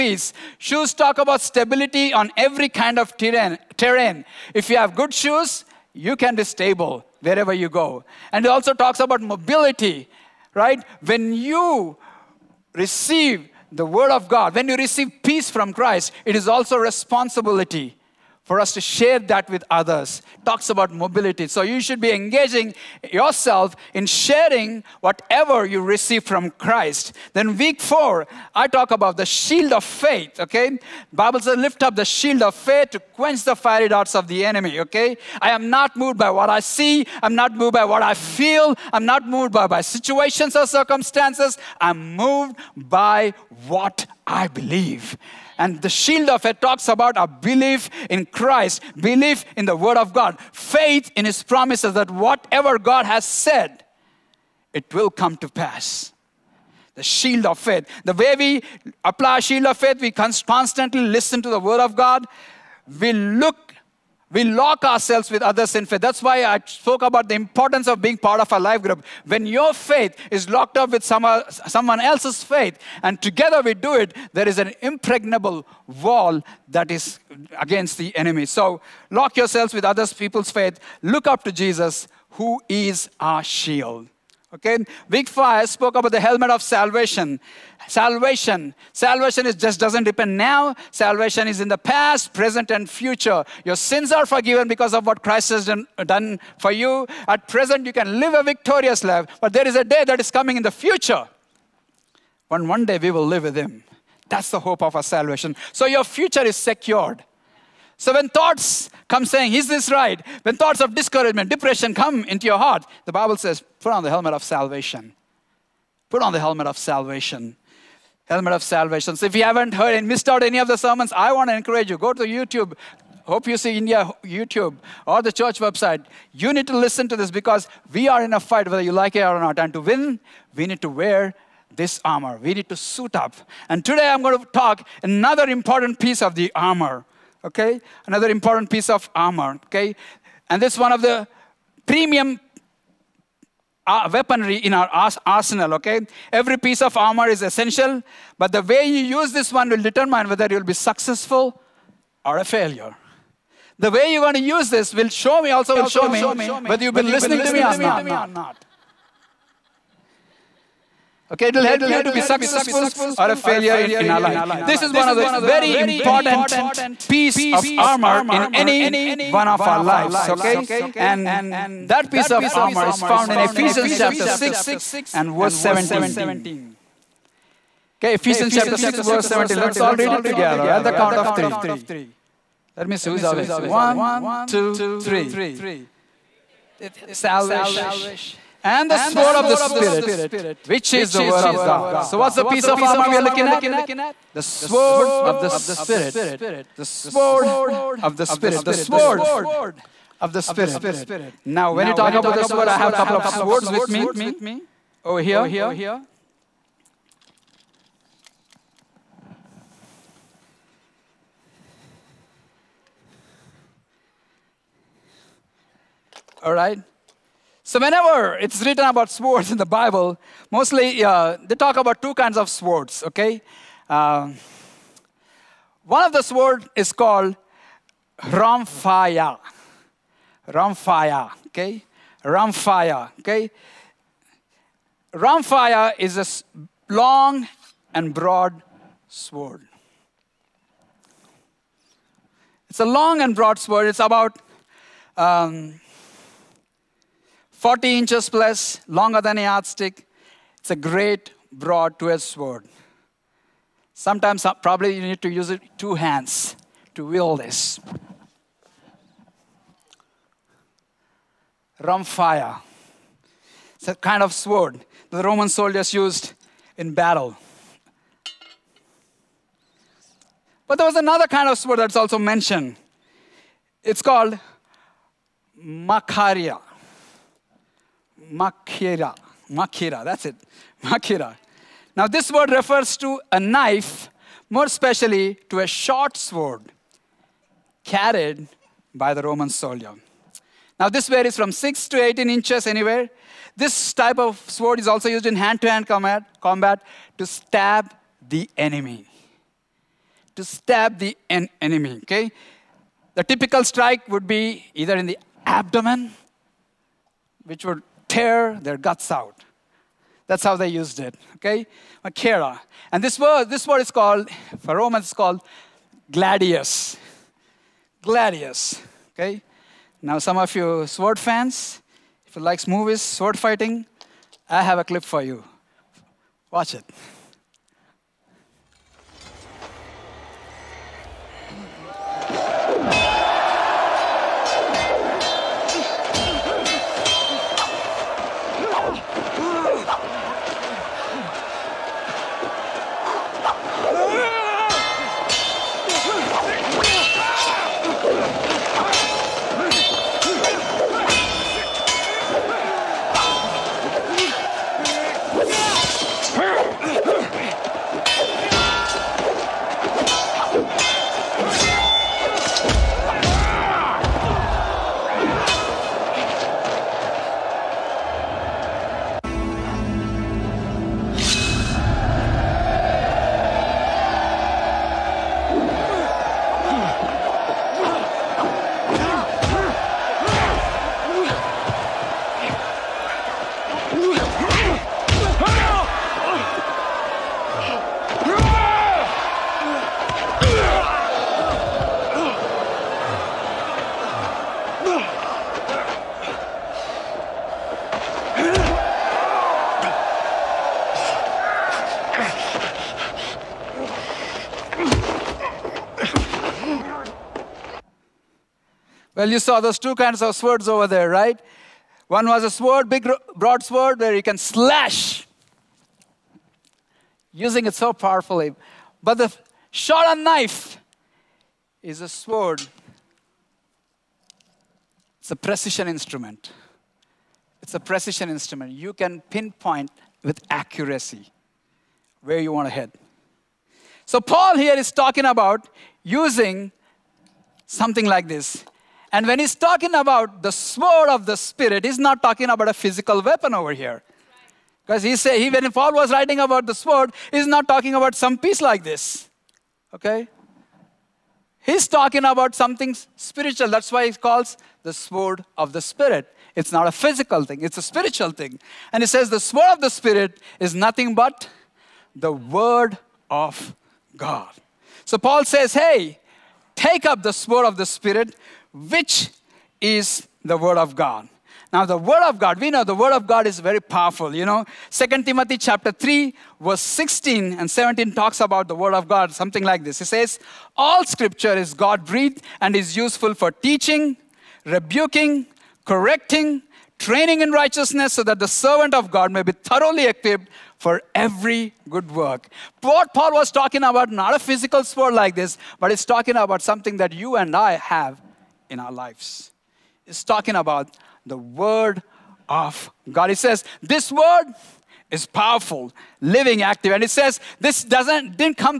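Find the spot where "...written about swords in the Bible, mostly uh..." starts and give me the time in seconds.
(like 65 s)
218 s.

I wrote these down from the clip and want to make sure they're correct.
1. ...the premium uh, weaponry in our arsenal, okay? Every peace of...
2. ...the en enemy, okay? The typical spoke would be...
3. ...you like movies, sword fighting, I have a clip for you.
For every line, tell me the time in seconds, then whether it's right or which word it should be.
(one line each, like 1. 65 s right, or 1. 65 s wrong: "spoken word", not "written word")
1. 141 s wrong: "piece", not "peace"
2. 300 s wrong: "strike", not "spoke"
3. 322 s right.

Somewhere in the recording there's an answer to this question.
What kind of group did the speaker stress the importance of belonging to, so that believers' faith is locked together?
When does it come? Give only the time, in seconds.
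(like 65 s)
68 s.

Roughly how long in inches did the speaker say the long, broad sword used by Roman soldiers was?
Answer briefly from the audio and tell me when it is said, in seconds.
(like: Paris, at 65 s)
40 inches plus, at 247 s.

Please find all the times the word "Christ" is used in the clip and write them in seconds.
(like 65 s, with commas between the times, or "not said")
15 s, 26 s, 48 s, 95 s.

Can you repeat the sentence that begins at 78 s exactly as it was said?
So lock yourselves with others people's faith.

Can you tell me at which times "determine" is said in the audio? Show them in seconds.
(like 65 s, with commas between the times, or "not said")
149 s.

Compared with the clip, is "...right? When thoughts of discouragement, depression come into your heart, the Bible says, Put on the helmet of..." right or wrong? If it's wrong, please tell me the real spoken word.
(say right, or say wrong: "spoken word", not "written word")
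right.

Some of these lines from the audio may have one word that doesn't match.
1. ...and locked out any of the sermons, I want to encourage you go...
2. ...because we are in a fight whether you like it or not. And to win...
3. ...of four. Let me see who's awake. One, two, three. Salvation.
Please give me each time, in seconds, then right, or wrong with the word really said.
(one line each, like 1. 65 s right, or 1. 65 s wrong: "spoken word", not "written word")
1. 119 s wrong: "missed", not "locked"
2. 127 s right
3. 181 s wrong: "three", not "four".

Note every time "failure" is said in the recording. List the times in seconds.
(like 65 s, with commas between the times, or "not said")
152 s, 163 s.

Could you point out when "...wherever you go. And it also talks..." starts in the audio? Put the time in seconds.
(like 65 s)
7 s.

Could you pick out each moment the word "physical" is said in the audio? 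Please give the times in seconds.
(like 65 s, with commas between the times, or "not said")
442 s, 456 s, 494 s.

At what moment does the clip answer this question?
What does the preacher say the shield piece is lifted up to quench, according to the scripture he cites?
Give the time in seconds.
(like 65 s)
33 s.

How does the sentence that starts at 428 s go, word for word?
You can pinpoint with accuracy where you want to head.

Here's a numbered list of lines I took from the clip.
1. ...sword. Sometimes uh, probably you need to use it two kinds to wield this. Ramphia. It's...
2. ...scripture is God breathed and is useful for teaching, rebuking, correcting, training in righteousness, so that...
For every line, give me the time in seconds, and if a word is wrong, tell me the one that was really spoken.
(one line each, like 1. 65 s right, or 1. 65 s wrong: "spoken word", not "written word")
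1. 252 s wrong: "hands", not "kinds"
2. 481 s right.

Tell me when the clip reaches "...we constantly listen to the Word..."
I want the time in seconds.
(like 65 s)
60 s.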